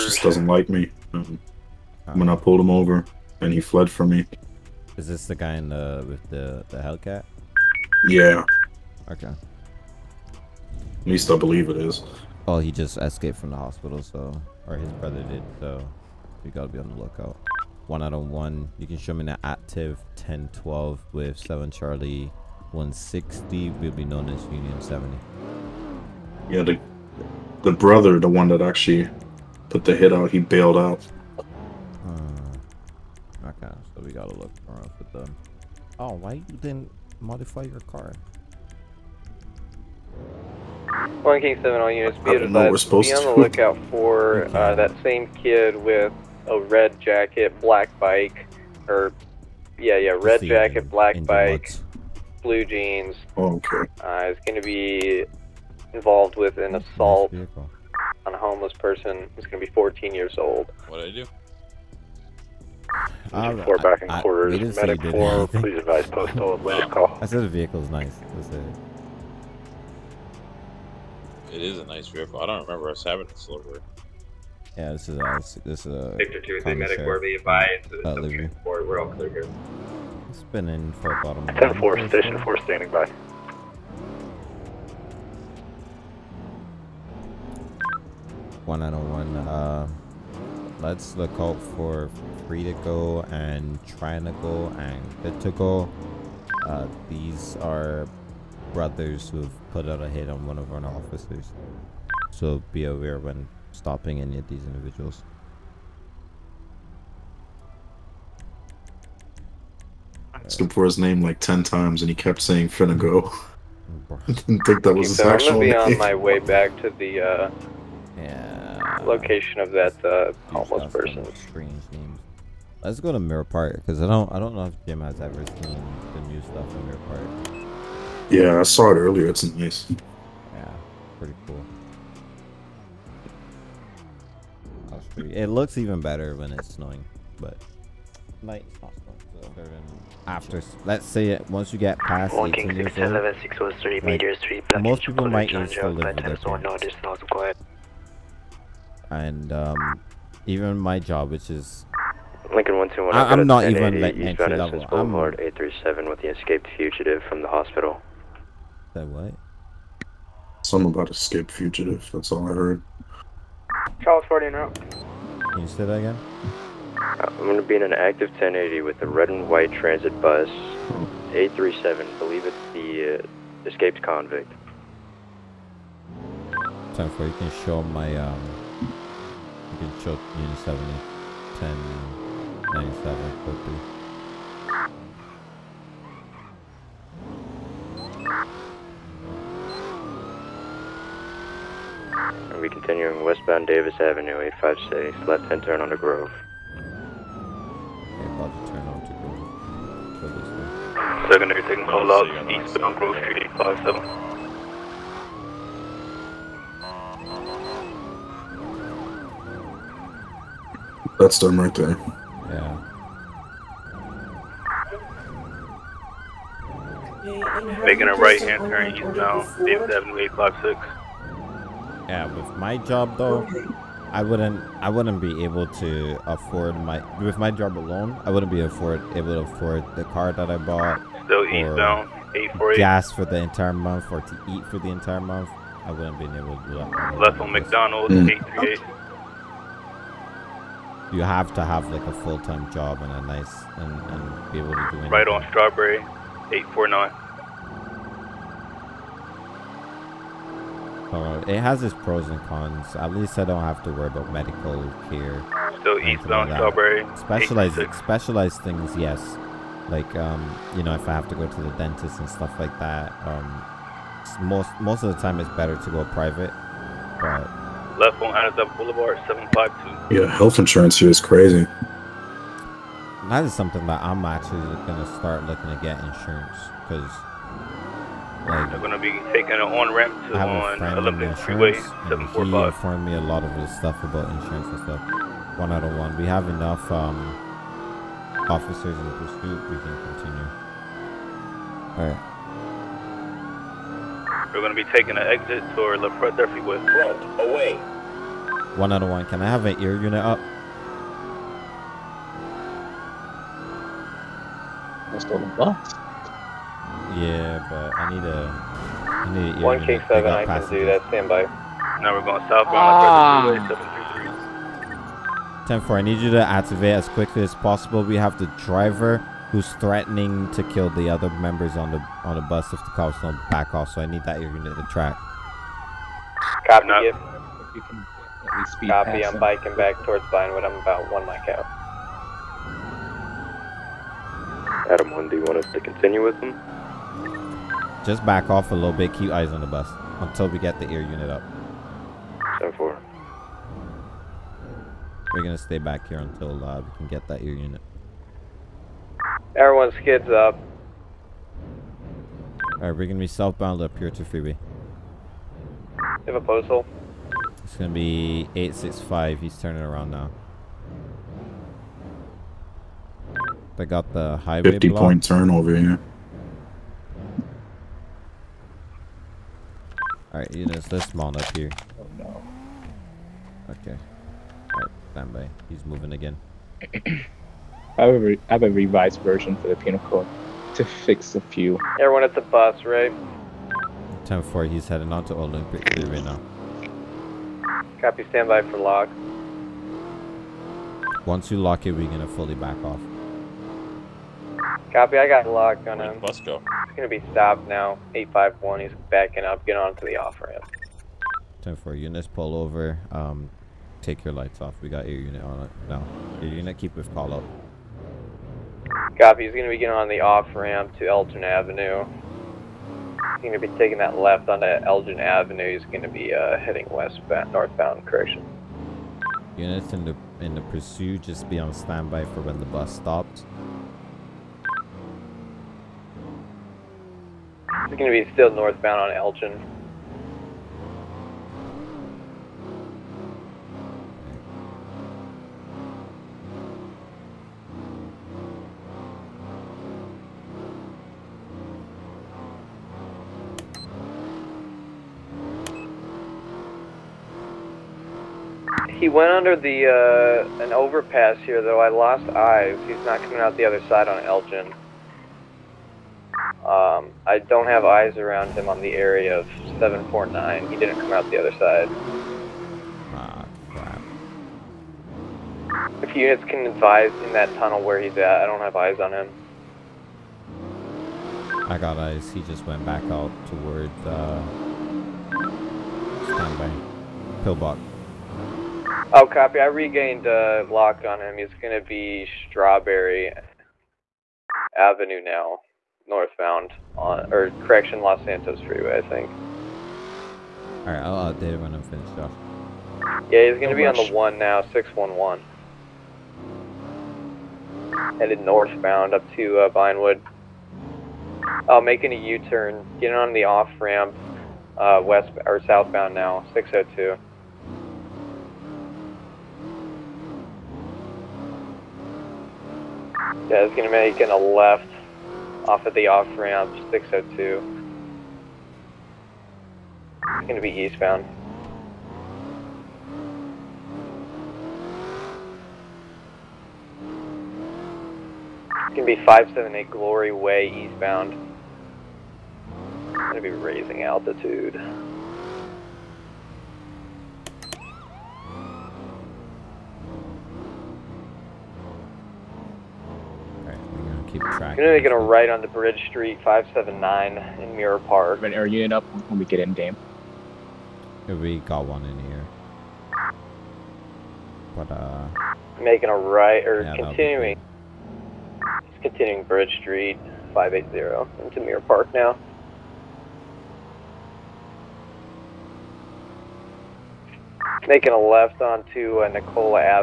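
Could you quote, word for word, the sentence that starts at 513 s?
Yeah, it's gonna make a left off of the off ramp 602.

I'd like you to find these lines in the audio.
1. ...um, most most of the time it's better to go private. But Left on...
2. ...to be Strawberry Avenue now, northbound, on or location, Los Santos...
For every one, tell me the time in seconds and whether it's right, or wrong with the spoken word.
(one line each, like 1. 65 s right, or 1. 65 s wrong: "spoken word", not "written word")
1. 263 s right
2. 481 s wrong: "correction", not "location".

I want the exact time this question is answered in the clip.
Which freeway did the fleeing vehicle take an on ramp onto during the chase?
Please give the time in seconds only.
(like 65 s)
280 s.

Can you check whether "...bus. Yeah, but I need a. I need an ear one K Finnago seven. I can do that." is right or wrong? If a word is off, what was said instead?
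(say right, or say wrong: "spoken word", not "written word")
wrong: "One", not "Finnago".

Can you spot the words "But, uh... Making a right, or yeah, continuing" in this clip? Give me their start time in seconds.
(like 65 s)
554 s.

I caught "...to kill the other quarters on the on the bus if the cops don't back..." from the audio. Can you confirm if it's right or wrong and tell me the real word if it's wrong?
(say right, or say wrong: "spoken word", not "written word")
wrong: "members", not "quarters".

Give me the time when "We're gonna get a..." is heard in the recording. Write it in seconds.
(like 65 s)
544 s.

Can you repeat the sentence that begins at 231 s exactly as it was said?
Still eastbound, Gas for the entire month or to eat for the entire month.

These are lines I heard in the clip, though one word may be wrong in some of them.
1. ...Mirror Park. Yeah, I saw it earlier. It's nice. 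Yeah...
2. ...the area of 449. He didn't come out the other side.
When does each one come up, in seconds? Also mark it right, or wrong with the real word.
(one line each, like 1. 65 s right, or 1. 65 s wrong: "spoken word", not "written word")
1. 126 s right
2. 458 s wrong: "749", not "449".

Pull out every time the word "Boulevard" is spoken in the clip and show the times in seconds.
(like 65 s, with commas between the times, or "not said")
154 s, 268 s.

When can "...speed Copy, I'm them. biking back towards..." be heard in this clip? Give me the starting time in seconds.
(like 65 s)
328 s.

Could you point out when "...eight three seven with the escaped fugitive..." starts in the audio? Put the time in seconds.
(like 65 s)
155 s.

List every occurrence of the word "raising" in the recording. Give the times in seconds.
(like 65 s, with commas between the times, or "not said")
533 s.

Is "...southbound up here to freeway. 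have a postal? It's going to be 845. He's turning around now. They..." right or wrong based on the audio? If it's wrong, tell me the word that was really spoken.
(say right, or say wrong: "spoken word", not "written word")
wrong: "865", not "845".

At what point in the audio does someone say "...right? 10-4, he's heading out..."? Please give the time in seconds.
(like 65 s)
382 s.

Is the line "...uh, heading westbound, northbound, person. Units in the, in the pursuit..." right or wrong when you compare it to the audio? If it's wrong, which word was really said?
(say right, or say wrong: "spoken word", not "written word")
wrong: "correction", not "person".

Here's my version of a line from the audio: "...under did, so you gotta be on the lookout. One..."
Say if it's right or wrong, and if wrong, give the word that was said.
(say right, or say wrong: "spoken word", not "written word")
wrong: "brother", not "under".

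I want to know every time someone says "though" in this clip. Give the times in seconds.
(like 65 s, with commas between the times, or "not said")
223 s, 451 s.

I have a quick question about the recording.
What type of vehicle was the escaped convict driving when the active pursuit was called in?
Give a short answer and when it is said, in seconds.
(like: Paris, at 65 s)
transit bus, at 169 s.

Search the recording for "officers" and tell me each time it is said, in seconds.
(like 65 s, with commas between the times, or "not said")
100 s, 288 s.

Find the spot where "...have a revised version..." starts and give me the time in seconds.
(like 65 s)
378 s.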